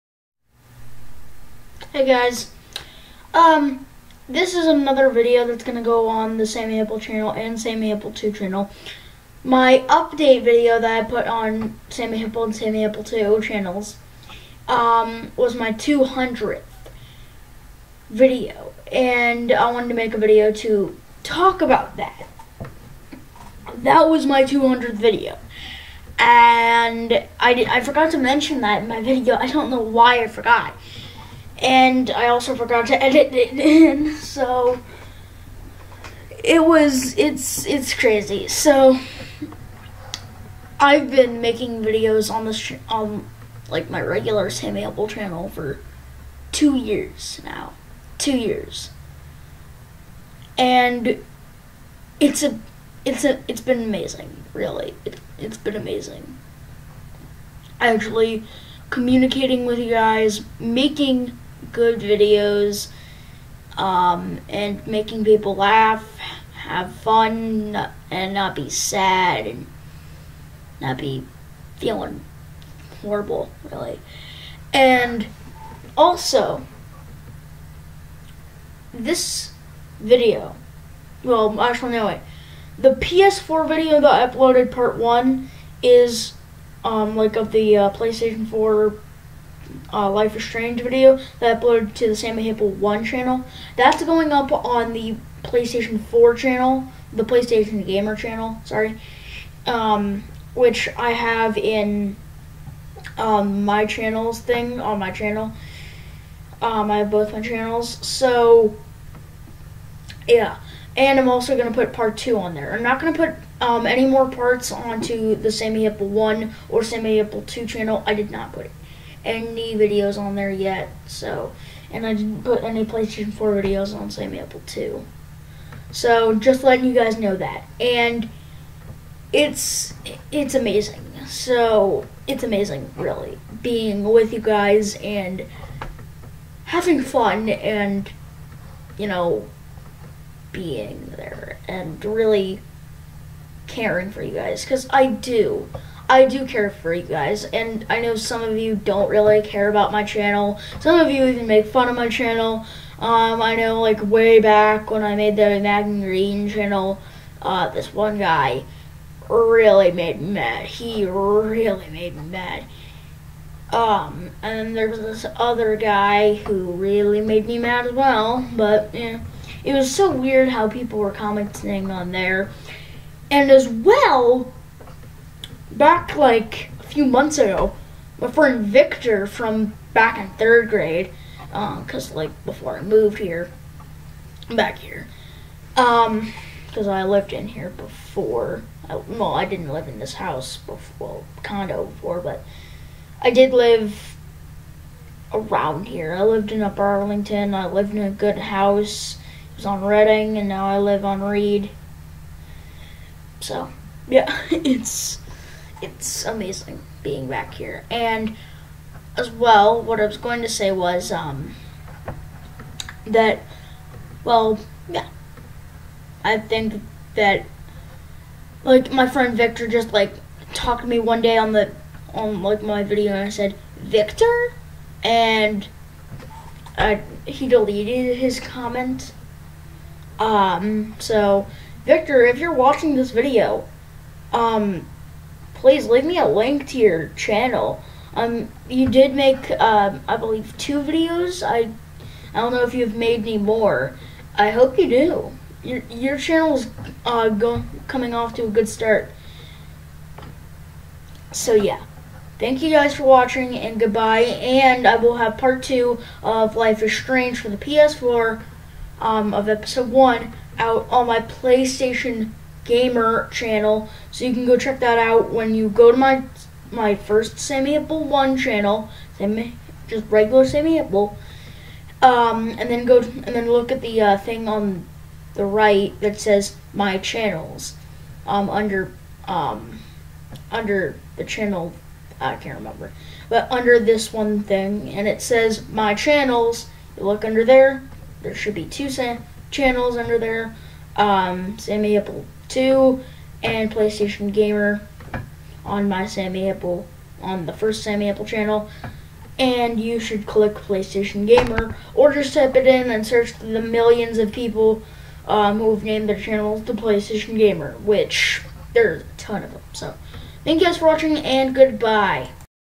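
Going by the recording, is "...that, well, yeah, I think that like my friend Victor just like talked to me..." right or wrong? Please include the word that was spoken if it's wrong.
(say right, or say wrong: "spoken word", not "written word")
right.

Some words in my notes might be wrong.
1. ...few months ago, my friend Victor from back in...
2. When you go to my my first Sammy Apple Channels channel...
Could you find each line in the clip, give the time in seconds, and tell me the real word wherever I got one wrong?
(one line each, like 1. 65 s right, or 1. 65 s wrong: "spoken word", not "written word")
1. 176 s right
2. 265 s wrong: "One", not "Channels".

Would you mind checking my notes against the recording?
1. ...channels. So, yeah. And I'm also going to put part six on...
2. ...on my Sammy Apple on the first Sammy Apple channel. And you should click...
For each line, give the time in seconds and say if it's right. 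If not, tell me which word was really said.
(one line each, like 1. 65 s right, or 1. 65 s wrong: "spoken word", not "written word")
1. 107 s wrong: "two", not "six"
2. 295 s right.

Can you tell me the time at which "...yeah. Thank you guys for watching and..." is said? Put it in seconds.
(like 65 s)
251 s.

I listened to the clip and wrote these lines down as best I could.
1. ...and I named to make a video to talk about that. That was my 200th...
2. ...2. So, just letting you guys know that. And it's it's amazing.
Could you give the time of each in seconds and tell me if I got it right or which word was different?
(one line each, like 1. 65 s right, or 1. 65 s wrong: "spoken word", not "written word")
1. 18 s wrong: "wanted", not "named"
2. 124 s right.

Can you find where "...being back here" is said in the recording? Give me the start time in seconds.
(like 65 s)
207 s.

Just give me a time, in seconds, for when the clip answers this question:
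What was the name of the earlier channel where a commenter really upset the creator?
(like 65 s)
155 s.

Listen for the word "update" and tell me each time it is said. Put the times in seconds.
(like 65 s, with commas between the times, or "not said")
9 s.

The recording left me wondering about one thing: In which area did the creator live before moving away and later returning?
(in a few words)
Upper Arlington.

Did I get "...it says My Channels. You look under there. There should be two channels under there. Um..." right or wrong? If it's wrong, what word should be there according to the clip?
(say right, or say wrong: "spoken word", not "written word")
right.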